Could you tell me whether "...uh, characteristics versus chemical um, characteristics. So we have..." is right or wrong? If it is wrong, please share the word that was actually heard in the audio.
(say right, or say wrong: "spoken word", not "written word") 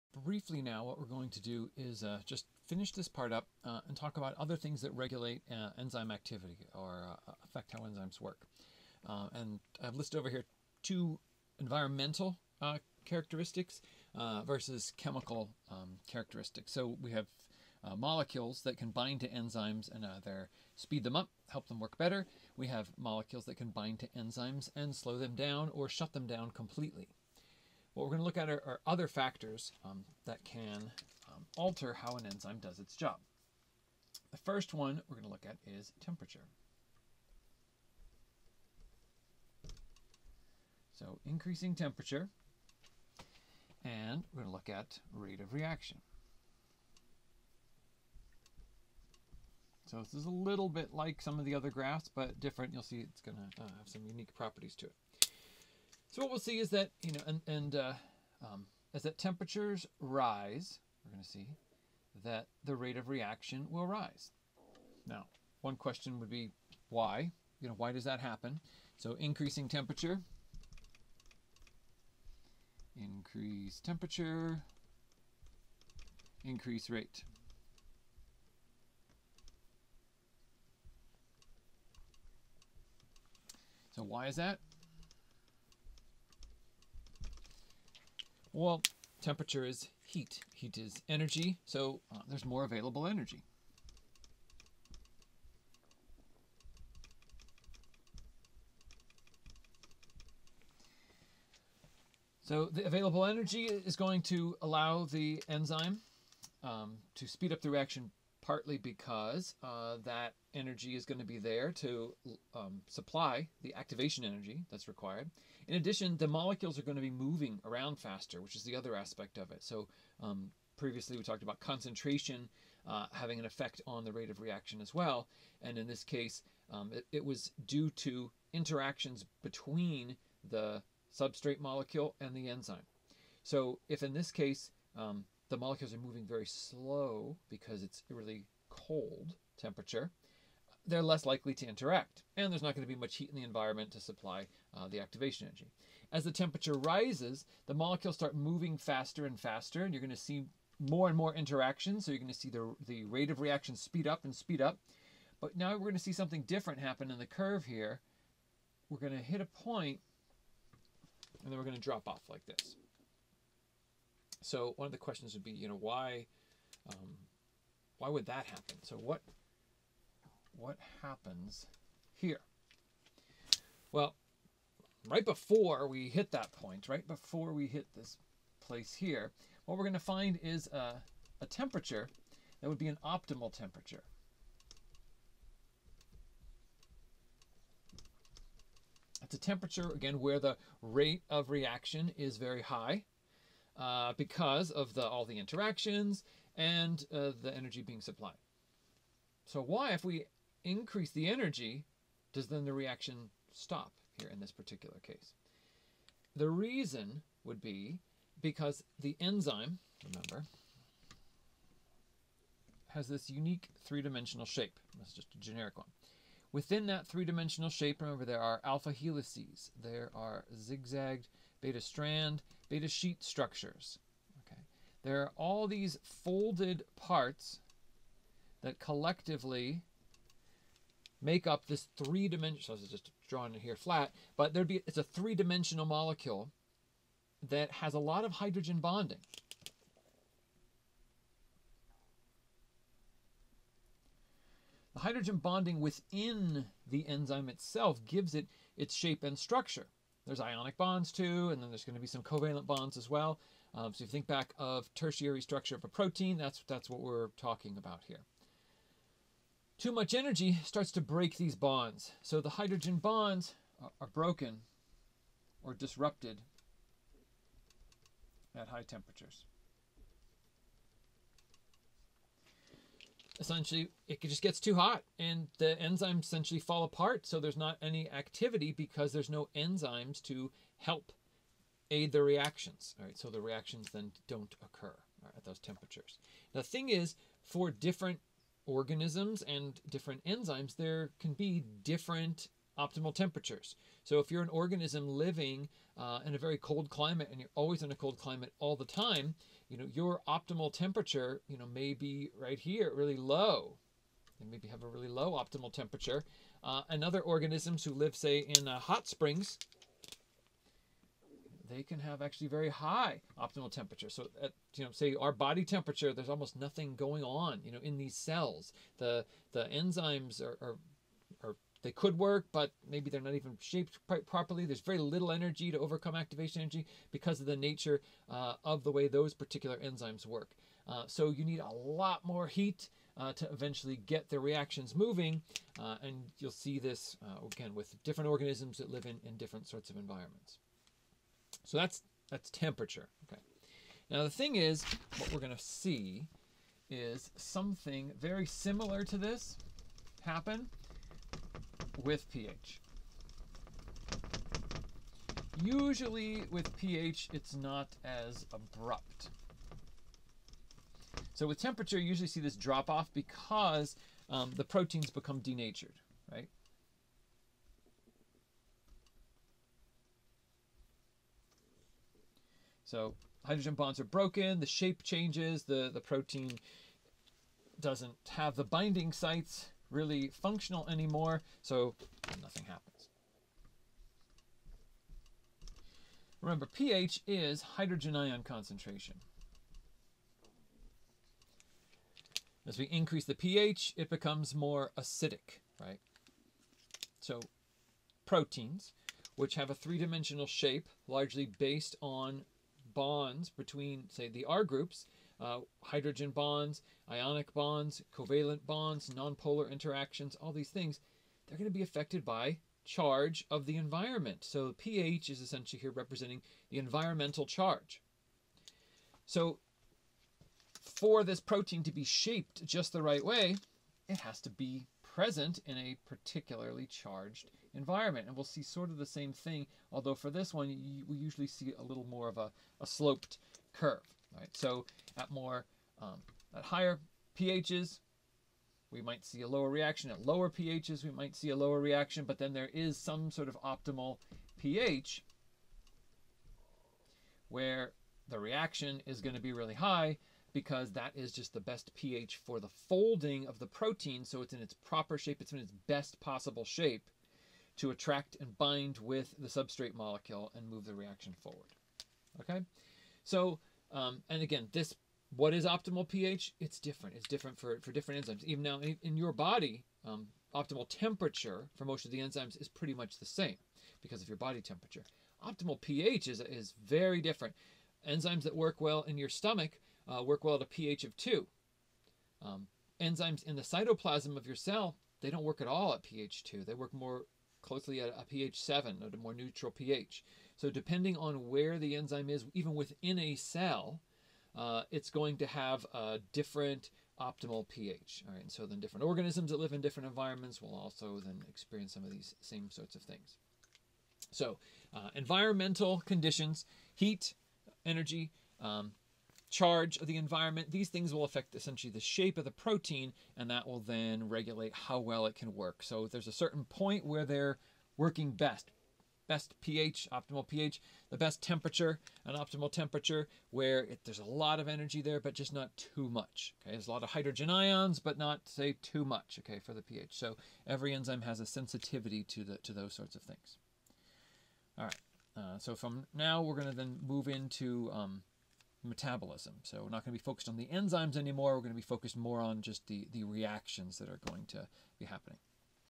right.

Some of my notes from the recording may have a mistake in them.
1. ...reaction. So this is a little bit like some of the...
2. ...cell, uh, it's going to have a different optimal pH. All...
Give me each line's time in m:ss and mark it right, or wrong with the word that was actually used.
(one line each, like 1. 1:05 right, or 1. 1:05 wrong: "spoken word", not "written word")
1. 0:45 right
2. 8:13 right.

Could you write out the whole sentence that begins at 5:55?
Usually with pH, it's not as abrupt.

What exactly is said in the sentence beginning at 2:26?
As the temperature rises, the molecules start moving faster and faster, and you're going to see more and more interactions.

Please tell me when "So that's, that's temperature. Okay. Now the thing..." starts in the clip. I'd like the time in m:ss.
5:41.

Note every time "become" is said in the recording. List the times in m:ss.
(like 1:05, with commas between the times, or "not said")
6:05, 6:34.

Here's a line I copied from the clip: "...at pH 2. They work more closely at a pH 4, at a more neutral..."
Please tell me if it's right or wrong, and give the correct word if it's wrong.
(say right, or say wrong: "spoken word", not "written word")
wrong: "7", not "4".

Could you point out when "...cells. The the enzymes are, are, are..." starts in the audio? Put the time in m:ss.
5:18.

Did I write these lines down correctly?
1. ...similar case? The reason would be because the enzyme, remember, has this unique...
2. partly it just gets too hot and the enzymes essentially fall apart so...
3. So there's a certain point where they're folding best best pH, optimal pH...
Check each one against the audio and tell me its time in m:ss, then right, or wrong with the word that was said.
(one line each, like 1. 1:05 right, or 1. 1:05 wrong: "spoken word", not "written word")
1. 3:24 wrong: "particular", not "similar"
2. 4:33 wrong: "essentially", not "partly"
3. 8:35 wrong: "working", not "folding".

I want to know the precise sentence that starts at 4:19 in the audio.
Too much energy starts to break these bonds.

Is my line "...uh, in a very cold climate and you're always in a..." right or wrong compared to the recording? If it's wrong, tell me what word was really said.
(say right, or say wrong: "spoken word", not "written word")
right.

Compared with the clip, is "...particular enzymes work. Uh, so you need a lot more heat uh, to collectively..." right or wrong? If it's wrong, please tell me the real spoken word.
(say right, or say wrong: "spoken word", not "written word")
wrong: "eventually", not "collectively".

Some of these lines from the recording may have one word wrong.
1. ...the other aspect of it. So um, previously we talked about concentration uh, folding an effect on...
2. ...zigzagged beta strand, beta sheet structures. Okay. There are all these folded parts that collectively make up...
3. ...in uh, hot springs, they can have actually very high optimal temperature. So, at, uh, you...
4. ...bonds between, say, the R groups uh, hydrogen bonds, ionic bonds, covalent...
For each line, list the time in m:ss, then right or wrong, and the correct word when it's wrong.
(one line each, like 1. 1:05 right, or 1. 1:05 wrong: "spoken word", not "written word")
1. 1:58 wrong: "having", not "folding"
2. 3:40 right
3. 5:08 right
4. 6:42 right.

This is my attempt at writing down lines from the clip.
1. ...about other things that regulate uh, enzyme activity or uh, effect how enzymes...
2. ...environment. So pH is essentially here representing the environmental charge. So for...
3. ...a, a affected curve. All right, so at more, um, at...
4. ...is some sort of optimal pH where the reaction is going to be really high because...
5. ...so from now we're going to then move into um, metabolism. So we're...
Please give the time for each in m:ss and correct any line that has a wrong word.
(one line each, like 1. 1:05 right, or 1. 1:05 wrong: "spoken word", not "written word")
1. 0:04 wrong: "affect", not "effect"
2. 6:53 right
3. 7:12 wrong: "sloped", not "affected"
4. 7:22 right
5. 8:55 right.